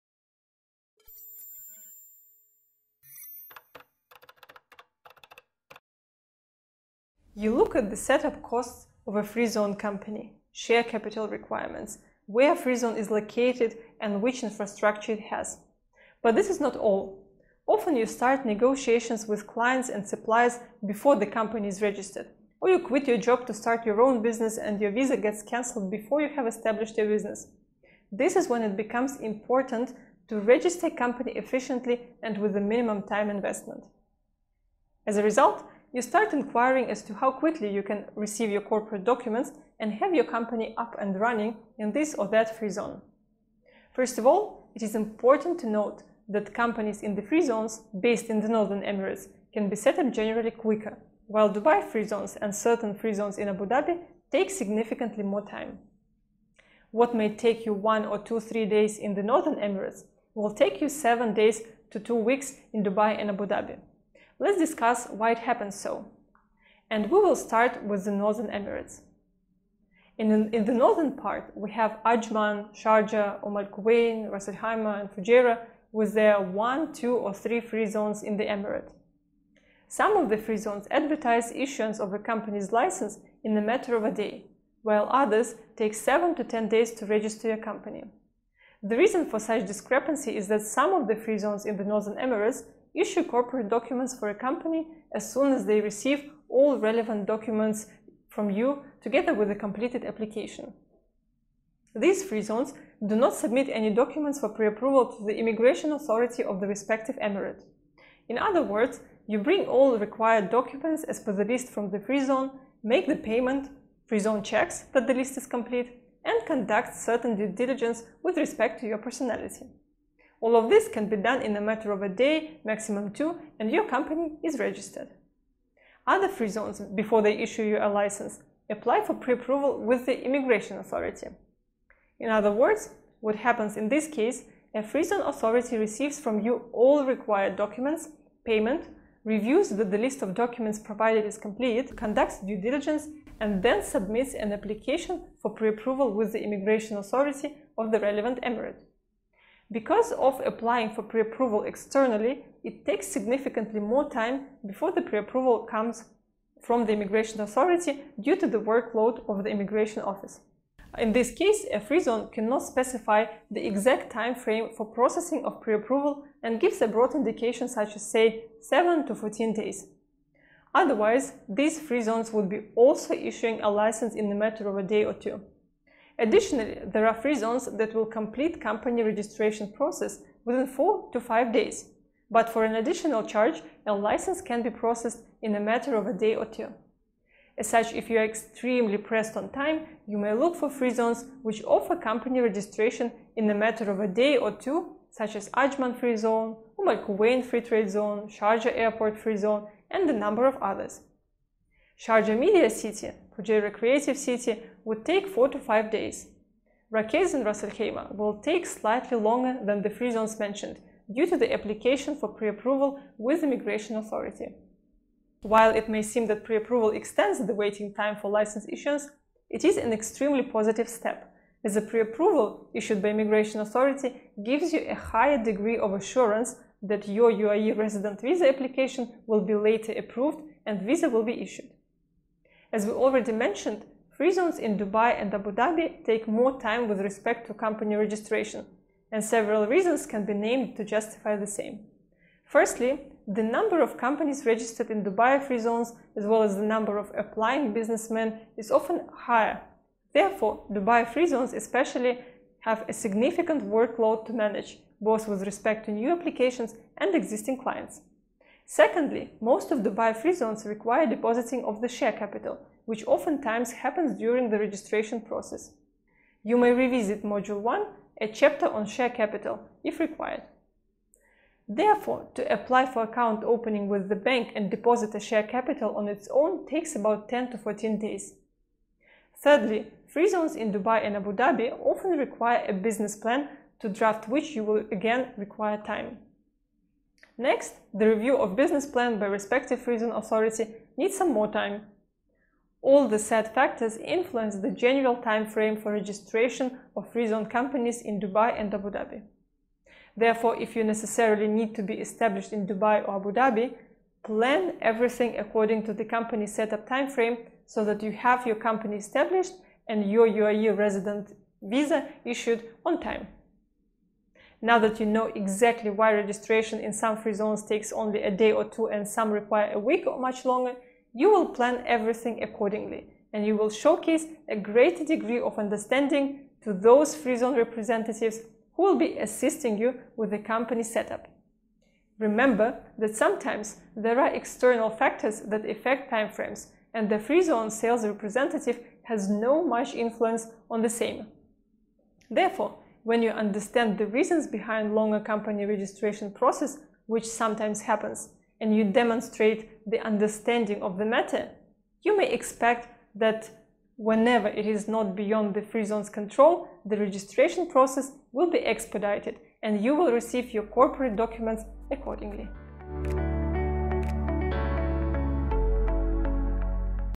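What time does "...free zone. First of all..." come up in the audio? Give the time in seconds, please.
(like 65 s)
42 s.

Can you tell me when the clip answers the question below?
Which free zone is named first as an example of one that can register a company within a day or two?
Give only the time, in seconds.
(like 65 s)
195 s.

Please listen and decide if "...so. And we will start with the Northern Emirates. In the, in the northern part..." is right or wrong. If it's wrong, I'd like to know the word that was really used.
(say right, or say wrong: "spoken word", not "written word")
right.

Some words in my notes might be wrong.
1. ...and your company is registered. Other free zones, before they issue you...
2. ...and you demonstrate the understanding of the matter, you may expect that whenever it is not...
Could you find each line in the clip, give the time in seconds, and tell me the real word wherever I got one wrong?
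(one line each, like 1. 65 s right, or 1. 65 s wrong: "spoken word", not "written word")
1. 123 s right
2. 348 s right.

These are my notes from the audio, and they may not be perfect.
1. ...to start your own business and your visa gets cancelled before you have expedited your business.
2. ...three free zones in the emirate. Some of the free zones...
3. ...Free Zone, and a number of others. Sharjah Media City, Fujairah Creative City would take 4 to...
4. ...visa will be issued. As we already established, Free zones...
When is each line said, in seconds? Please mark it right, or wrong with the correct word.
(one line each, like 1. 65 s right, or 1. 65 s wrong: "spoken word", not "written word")
1. 23 s wrong: "established", not "expedited"
2. 77 s right
3. 199 s right
4. 230 s wrong: "mentioned", not "established".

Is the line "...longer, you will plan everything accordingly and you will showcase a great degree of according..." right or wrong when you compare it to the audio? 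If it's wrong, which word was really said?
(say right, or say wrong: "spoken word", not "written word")
wrong: "understanding", not "according".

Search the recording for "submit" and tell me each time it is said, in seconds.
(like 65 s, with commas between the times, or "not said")
103 s, 143 s.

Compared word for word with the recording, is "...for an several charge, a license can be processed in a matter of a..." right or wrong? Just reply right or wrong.
wrong.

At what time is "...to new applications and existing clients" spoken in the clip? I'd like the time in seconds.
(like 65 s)
255 s.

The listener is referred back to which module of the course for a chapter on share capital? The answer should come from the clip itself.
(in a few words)
Module 1.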